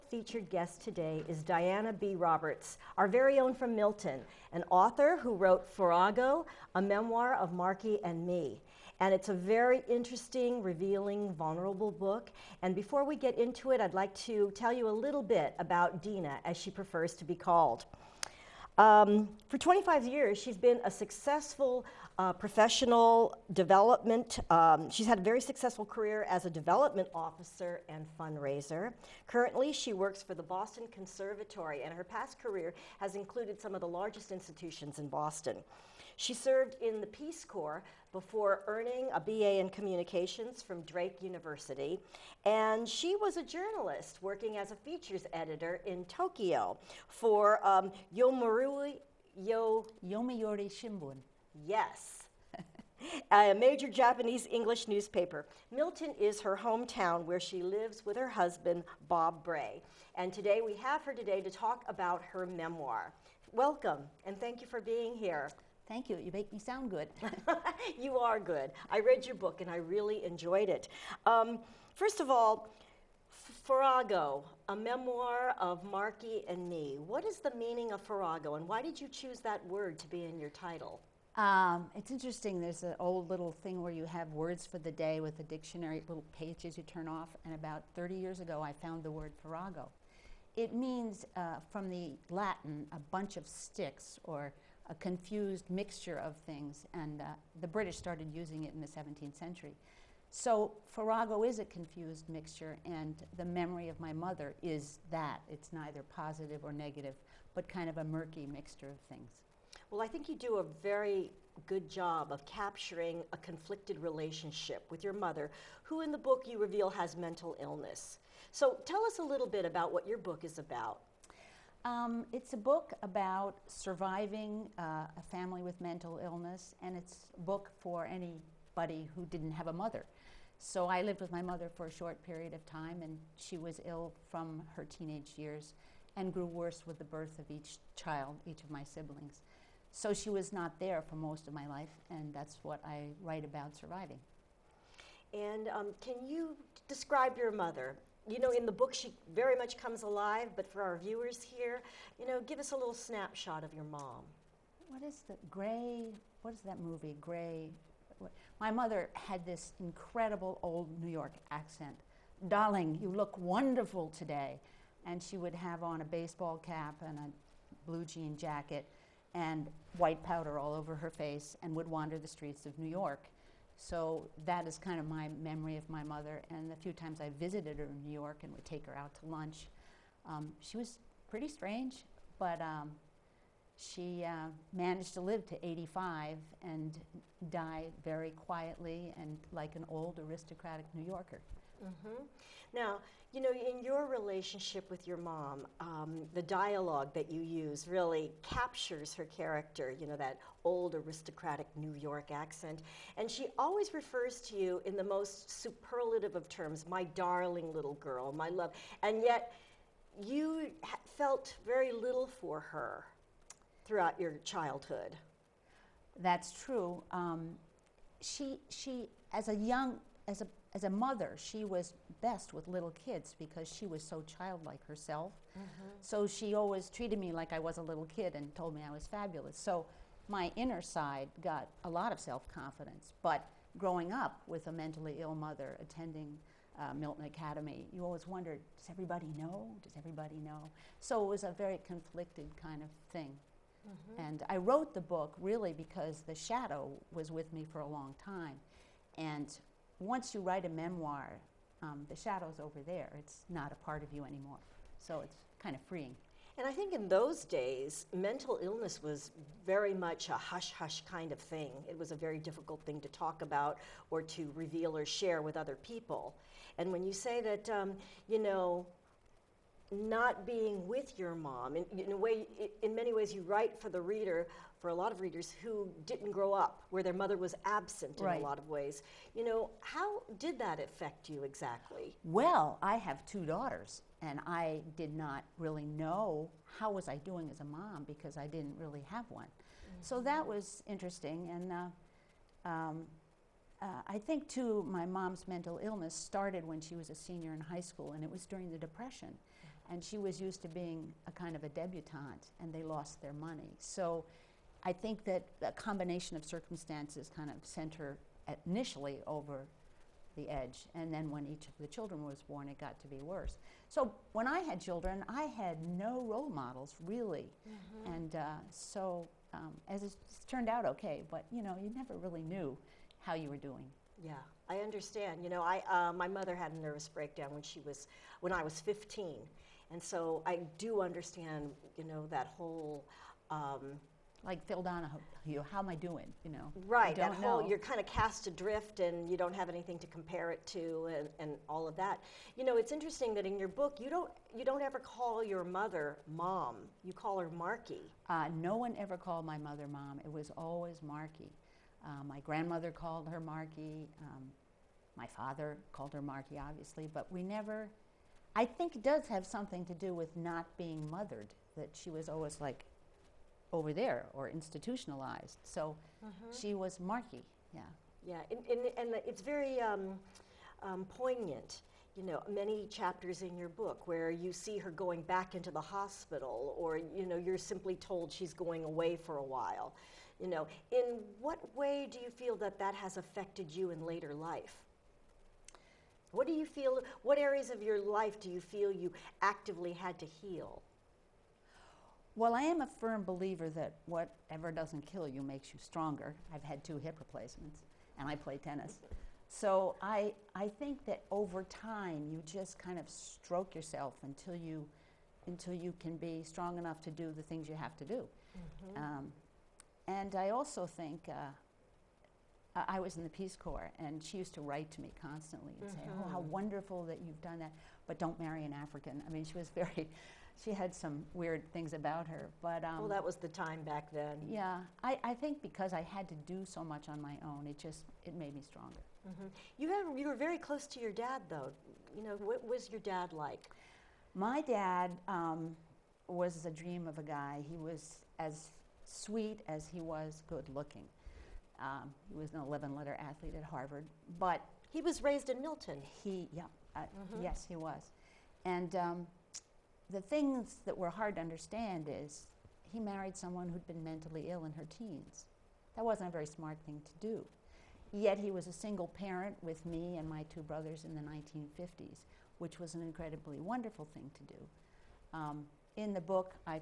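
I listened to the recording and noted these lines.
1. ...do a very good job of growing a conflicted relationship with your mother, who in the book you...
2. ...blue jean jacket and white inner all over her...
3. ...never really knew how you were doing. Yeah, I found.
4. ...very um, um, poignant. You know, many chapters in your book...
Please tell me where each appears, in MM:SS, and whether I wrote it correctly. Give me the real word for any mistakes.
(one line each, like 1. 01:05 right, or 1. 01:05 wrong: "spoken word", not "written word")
1. 01:50 wrong: "capturing", not "growing"
2. 02:47 wrong: "powder", not "inner"
3. 05:21 wrong: "understand", not "found"
4. 06:09 right.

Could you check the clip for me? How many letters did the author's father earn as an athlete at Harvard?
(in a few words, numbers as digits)
11.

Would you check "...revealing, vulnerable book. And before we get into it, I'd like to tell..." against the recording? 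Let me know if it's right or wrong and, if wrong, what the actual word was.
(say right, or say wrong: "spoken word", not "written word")
right.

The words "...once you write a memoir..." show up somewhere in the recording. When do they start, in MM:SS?
04:10.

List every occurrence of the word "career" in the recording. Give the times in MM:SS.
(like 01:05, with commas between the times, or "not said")
00:25, 00:32.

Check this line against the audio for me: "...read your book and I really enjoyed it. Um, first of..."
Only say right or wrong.
right.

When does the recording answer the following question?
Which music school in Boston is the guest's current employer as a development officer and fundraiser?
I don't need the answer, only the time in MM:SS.
00:30.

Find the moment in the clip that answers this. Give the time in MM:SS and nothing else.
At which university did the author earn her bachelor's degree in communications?
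00:40.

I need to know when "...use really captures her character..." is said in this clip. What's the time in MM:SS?
03:17.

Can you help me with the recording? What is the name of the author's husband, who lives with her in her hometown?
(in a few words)
Bob Bray.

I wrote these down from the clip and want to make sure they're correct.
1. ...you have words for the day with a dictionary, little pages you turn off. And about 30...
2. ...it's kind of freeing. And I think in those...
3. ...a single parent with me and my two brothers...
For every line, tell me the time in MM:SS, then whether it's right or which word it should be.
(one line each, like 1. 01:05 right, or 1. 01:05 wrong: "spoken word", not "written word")
1. 01:23 right
2. 04:15 right
3. 07:38 right.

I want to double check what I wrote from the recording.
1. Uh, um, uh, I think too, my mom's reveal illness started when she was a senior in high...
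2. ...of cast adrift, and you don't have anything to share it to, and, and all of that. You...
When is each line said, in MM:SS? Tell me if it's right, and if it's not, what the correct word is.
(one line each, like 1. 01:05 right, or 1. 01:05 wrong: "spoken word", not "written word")
1. 04:51 wrong: "mental", not "reveal"
2. 05:37 wrong: "compare", not "share".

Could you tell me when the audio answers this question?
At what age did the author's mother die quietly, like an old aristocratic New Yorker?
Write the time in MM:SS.
03:05.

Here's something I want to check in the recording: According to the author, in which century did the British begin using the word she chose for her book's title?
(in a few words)
17th century.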